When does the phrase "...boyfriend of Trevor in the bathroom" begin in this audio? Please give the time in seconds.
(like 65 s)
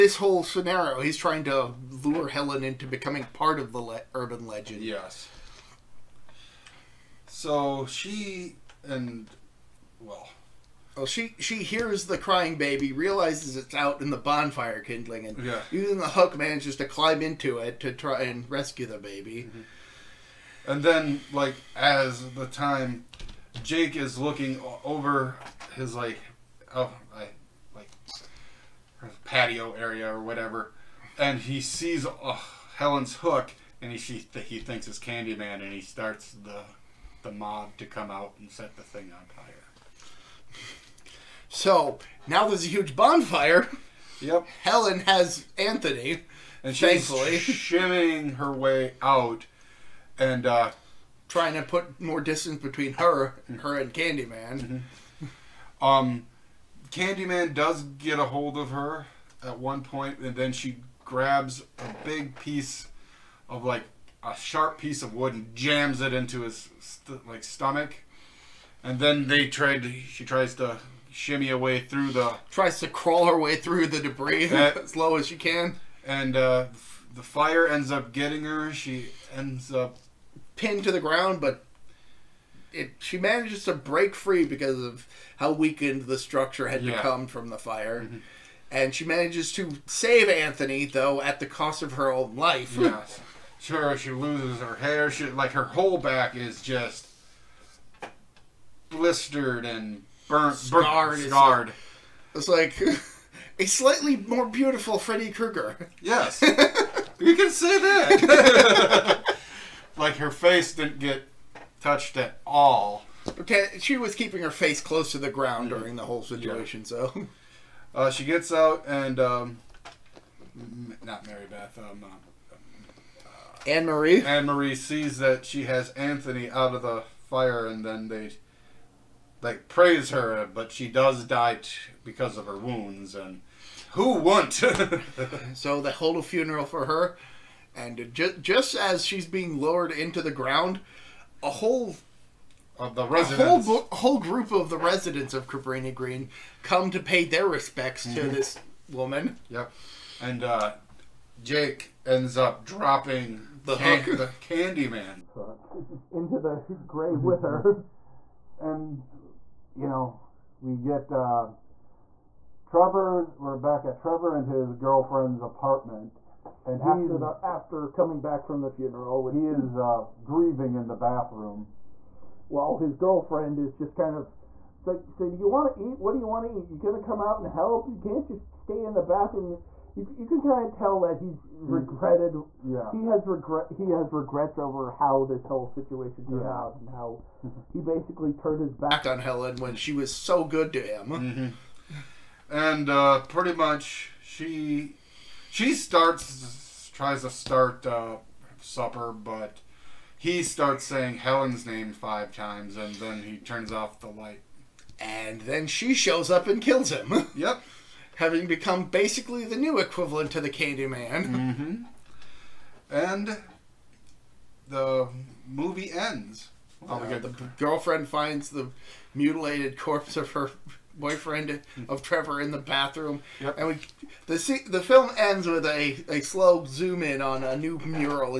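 220 s.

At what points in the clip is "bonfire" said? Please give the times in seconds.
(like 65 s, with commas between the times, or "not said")
14 s, 42 s.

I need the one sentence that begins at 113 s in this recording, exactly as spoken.
Okay, she was keeping her face close to the ground during the whole situation, yeah.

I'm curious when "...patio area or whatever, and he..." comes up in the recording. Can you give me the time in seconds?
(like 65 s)
29 s.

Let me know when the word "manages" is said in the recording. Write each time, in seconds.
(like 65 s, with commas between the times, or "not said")
16 s, 83 s, 89 s.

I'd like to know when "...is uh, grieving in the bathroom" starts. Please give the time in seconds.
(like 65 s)
169 s.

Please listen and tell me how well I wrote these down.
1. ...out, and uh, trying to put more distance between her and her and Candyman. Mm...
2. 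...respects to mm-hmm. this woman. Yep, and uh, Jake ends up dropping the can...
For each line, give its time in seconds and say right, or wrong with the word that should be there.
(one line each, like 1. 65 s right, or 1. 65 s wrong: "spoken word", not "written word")
1. 49 s right
2. 147 s right.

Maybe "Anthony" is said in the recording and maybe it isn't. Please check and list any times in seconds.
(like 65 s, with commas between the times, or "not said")
45 s, 90 s, 125 s.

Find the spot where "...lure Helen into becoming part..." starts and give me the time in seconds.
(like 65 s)
2 s.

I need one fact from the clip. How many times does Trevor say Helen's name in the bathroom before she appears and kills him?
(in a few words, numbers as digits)
5.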